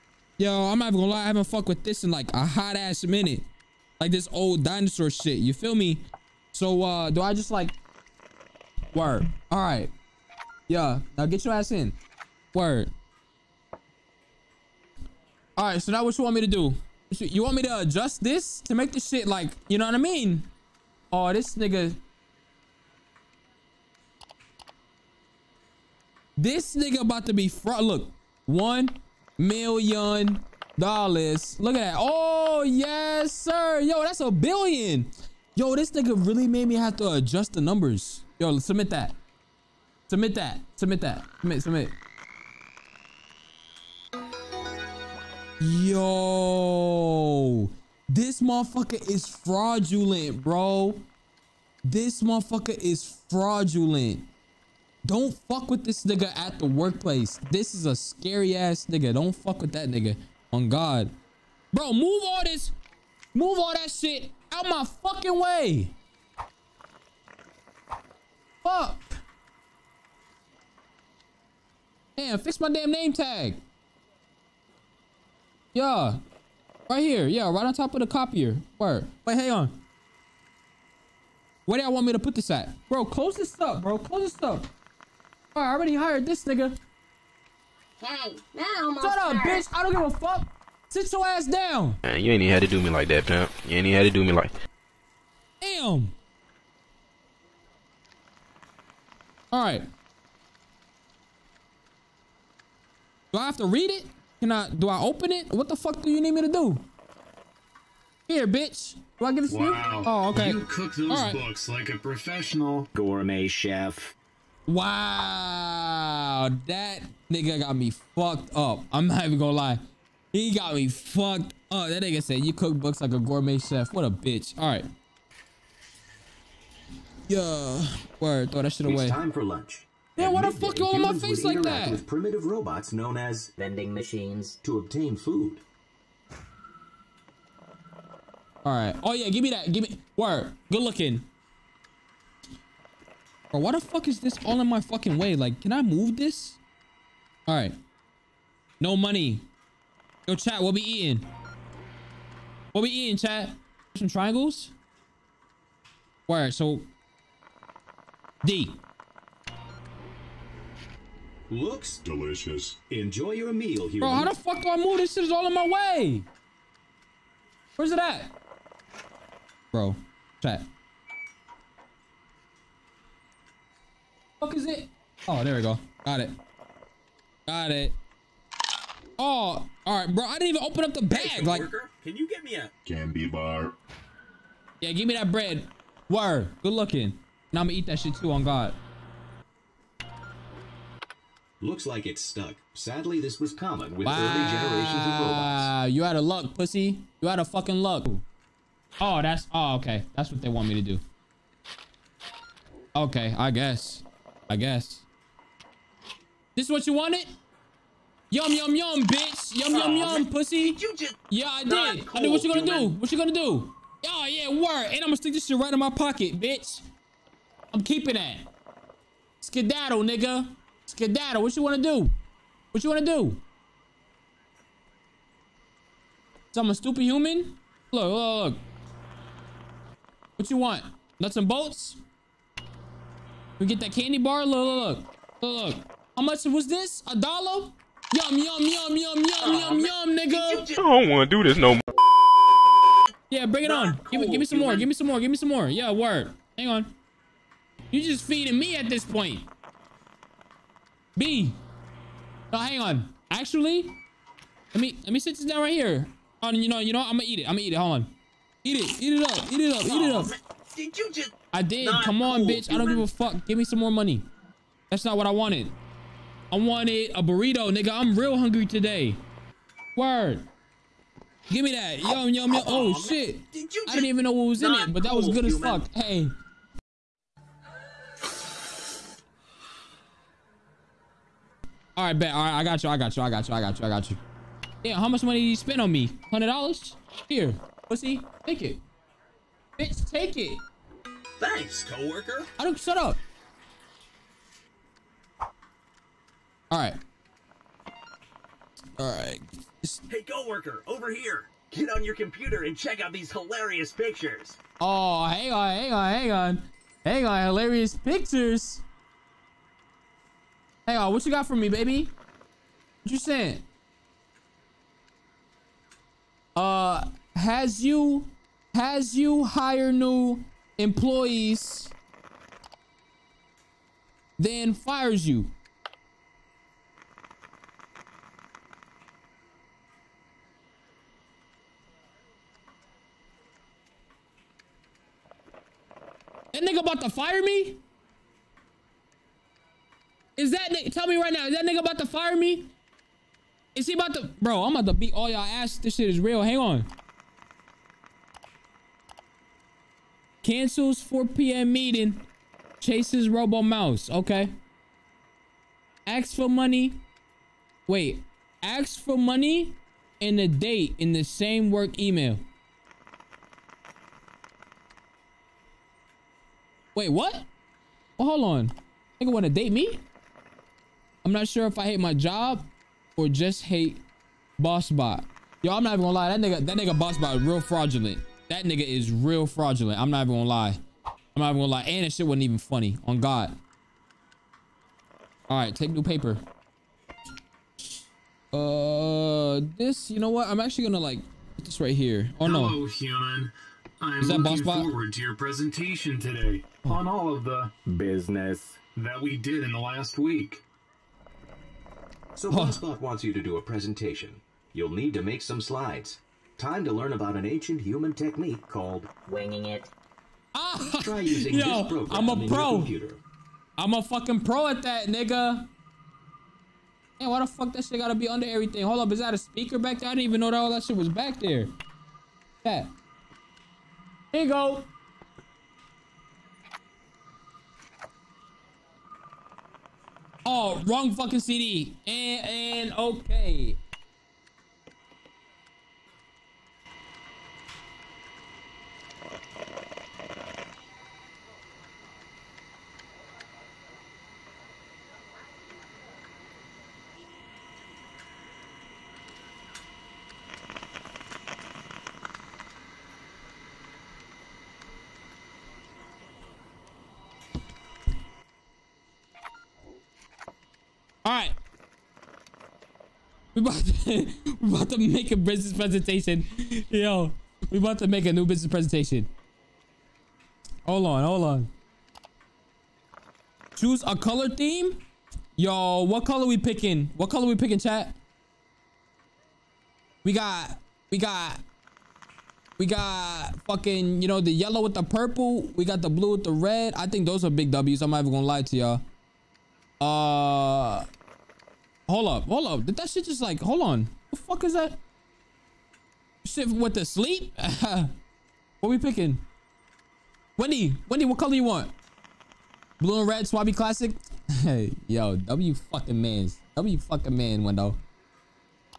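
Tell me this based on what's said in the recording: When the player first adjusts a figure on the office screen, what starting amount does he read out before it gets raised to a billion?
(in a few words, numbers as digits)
1 million.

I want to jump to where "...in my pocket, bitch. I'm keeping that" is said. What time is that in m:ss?
3:35.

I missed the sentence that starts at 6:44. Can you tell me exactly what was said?
You'll need to make some slides.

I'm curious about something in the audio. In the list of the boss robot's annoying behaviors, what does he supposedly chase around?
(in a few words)
Robo Mouse.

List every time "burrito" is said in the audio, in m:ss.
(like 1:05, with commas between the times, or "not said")
4:27.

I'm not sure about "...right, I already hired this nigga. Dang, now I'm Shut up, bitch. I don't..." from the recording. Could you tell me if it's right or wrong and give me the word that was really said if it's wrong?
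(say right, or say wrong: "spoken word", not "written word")
right.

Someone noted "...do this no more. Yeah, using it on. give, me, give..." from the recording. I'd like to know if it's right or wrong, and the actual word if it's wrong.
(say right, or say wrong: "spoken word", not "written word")
wrong: "bring", not "using".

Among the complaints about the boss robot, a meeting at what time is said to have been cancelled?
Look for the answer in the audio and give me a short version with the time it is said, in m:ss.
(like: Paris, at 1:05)
4 p.m., at 5:51.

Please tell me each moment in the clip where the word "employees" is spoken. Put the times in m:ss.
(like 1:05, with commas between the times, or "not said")
5:20.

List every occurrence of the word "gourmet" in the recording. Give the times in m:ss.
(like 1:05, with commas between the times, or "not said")
1:52, 2:03.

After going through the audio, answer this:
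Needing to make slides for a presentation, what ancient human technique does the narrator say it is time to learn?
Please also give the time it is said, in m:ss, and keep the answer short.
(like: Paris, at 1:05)
winging it, at 6:49.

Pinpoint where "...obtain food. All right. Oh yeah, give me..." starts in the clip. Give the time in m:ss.
2:14.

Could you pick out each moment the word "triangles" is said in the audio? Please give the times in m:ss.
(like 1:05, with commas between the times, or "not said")
2:34.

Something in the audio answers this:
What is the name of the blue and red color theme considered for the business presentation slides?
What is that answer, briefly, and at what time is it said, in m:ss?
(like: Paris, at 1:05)
Swabby Classic, at 8:23.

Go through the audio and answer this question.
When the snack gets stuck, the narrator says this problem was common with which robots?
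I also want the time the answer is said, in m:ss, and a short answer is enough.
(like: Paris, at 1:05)
early generations of robots, at 3:14.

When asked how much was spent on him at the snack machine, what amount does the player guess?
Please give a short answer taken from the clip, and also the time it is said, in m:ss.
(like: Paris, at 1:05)
100 dollars, at 4:46.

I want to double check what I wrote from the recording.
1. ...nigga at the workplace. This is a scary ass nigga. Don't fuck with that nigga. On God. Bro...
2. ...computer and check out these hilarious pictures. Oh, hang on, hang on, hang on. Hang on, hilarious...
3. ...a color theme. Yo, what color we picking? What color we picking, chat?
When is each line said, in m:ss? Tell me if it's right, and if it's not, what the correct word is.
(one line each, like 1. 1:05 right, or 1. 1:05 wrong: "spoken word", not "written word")
1. 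0:56 right
2. 5:02 right
3. 7:54 right.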